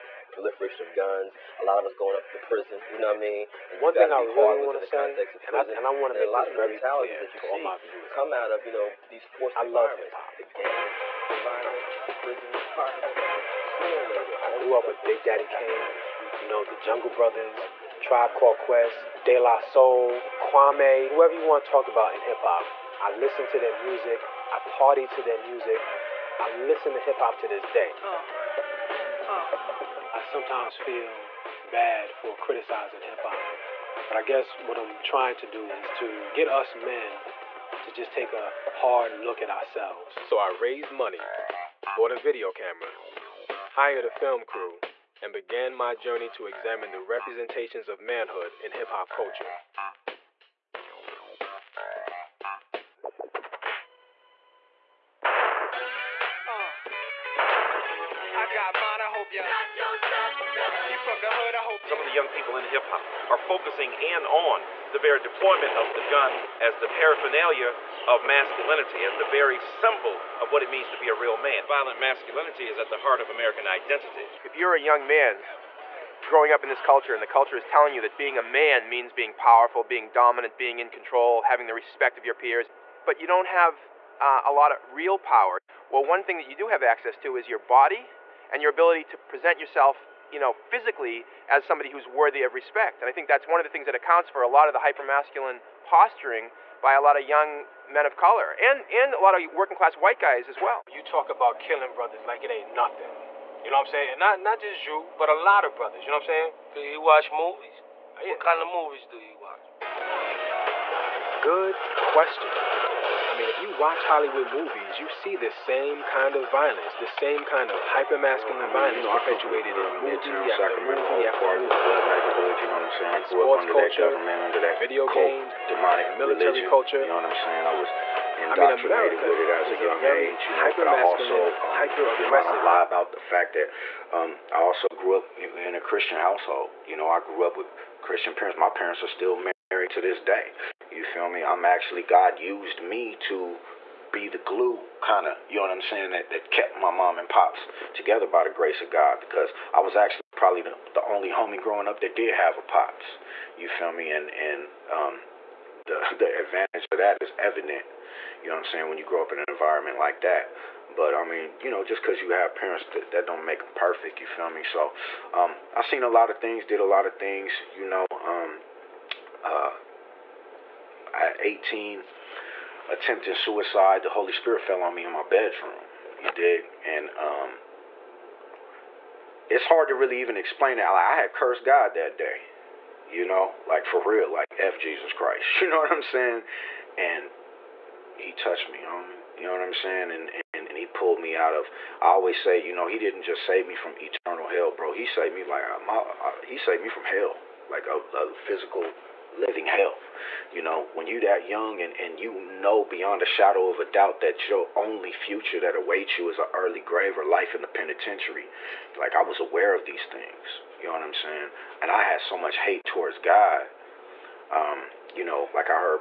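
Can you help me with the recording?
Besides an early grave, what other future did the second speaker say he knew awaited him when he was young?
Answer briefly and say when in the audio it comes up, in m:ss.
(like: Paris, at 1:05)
life in the penitentiary, at 3:27.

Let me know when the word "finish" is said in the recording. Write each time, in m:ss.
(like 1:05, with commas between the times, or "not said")
not said.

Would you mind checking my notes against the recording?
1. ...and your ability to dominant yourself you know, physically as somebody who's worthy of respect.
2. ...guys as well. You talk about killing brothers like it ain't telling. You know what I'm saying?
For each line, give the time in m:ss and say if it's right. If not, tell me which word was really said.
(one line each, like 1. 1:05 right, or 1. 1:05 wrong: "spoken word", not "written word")
1. 1:28 wrong: "present", not "dominant"
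2. 1:40 wrong: "nothing", not "telling".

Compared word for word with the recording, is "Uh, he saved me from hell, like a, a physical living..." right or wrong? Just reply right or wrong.
right.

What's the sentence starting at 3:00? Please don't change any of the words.
Like, I had cursed God that day, you know, like for real, like F Jesus Christ.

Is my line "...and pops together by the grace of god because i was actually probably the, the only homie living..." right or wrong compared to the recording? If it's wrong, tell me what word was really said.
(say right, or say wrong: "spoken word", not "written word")
wrong: "growing", not "living".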